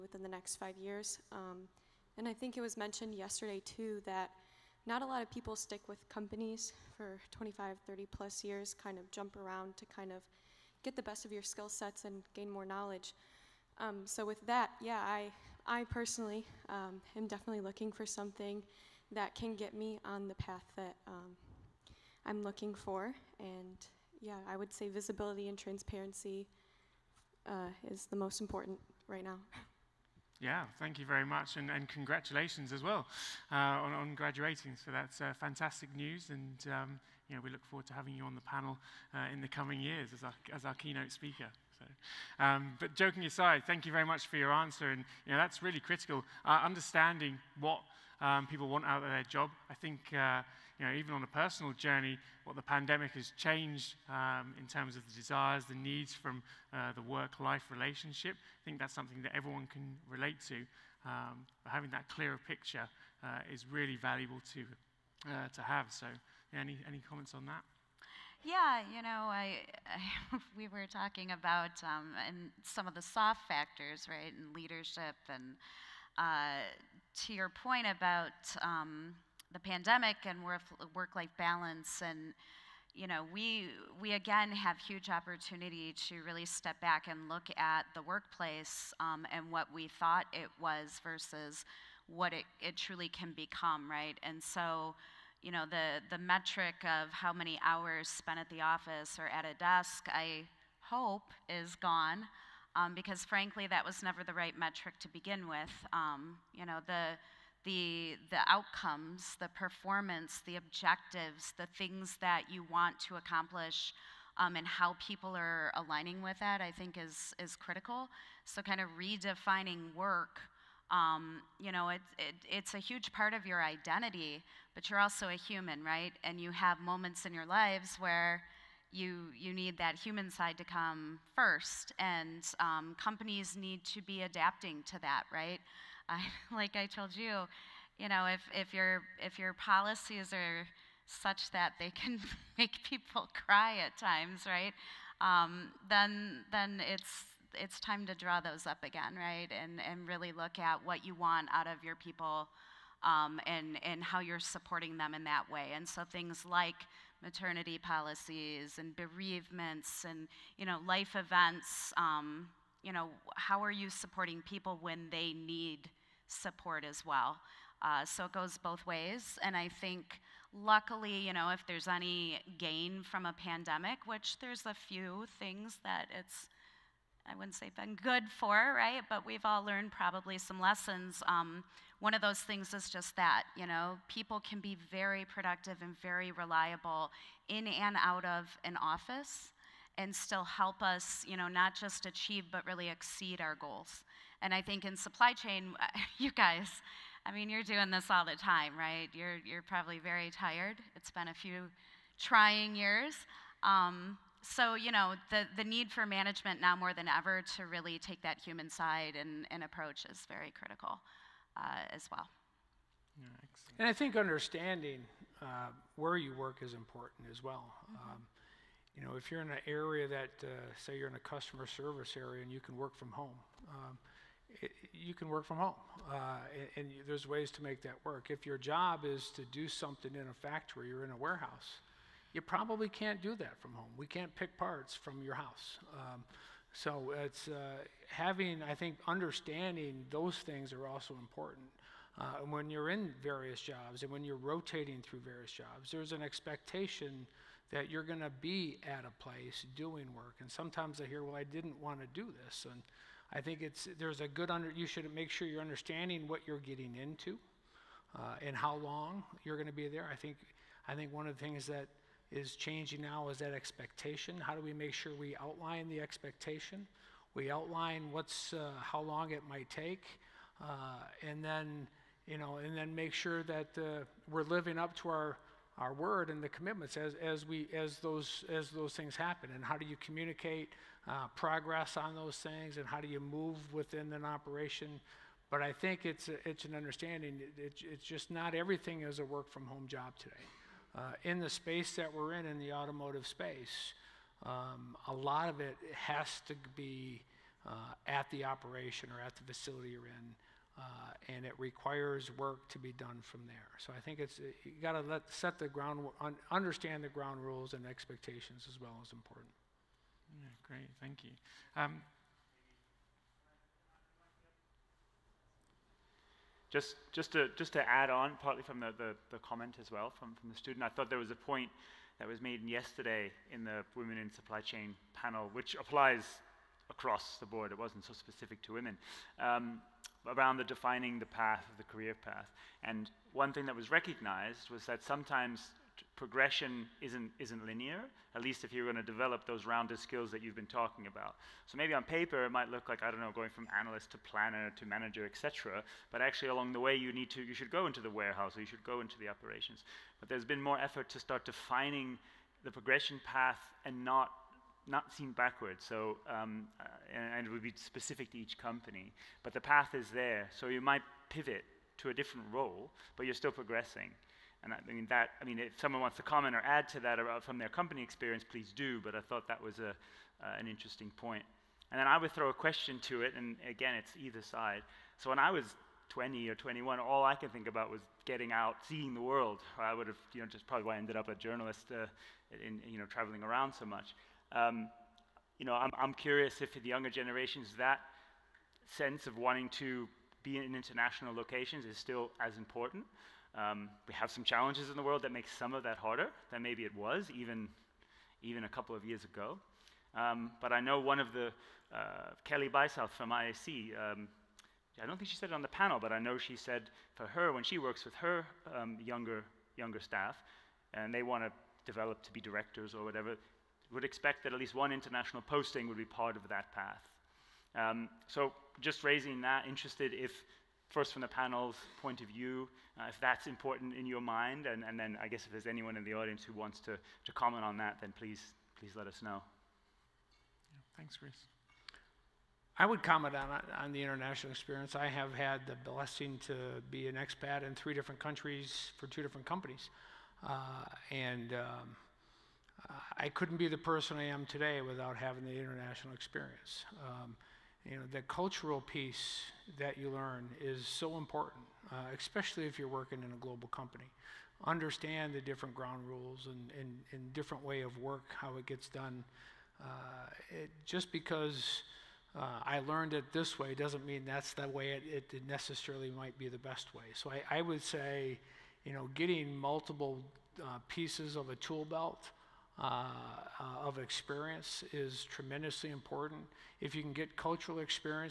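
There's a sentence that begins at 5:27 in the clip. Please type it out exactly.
It wasn't so specific to women.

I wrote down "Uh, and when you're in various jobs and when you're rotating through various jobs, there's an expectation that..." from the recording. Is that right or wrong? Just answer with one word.
right.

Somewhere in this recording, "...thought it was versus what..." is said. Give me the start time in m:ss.
1:29.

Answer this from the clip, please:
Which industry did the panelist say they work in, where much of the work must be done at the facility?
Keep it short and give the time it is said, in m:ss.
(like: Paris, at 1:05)
Automotive, at 4:52.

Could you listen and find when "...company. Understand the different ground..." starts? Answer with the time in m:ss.
7:33.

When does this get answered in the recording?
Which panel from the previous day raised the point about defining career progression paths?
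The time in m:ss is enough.
5:23.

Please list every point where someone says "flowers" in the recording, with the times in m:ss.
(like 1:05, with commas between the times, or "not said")
not said.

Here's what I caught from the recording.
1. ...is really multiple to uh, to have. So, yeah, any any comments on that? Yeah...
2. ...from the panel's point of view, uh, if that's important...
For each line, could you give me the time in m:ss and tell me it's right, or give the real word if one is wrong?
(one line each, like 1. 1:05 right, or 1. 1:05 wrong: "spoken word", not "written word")
1. 1:03 wrong: "valuable", not "multiple"
2. 7:01 right.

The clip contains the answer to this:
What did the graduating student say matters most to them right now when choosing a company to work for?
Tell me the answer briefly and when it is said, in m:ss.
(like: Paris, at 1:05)
Visibility and transparency, at 0:24.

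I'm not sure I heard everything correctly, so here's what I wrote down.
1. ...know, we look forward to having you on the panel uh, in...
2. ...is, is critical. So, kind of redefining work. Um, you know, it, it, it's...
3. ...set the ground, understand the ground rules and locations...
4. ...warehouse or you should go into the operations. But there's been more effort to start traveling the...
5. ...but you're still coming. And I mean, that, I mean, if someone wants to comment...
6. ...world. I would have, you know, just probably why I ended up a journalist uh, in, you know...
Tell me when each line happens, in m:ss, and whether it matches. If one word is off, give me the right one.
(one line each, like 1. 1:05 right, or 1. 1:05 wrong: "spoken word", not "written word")
1. 0:37 right
2. 1:56 right
3. 5:05 wrong: "expectations", not "locations"
4. 5:48 wrong: "defining", not "traveling"
5. 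6:03 wrong: "progressing", not "coming"
6. 6:19 right.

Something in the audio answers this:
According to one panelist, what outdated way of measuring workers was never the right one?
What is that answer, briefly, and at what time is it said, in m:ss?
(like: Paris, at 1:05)
How many hours spent at the office, at 1:37.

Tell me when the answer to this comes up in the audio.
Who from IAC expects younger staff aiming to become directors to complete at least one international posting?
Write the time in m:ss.
6:42.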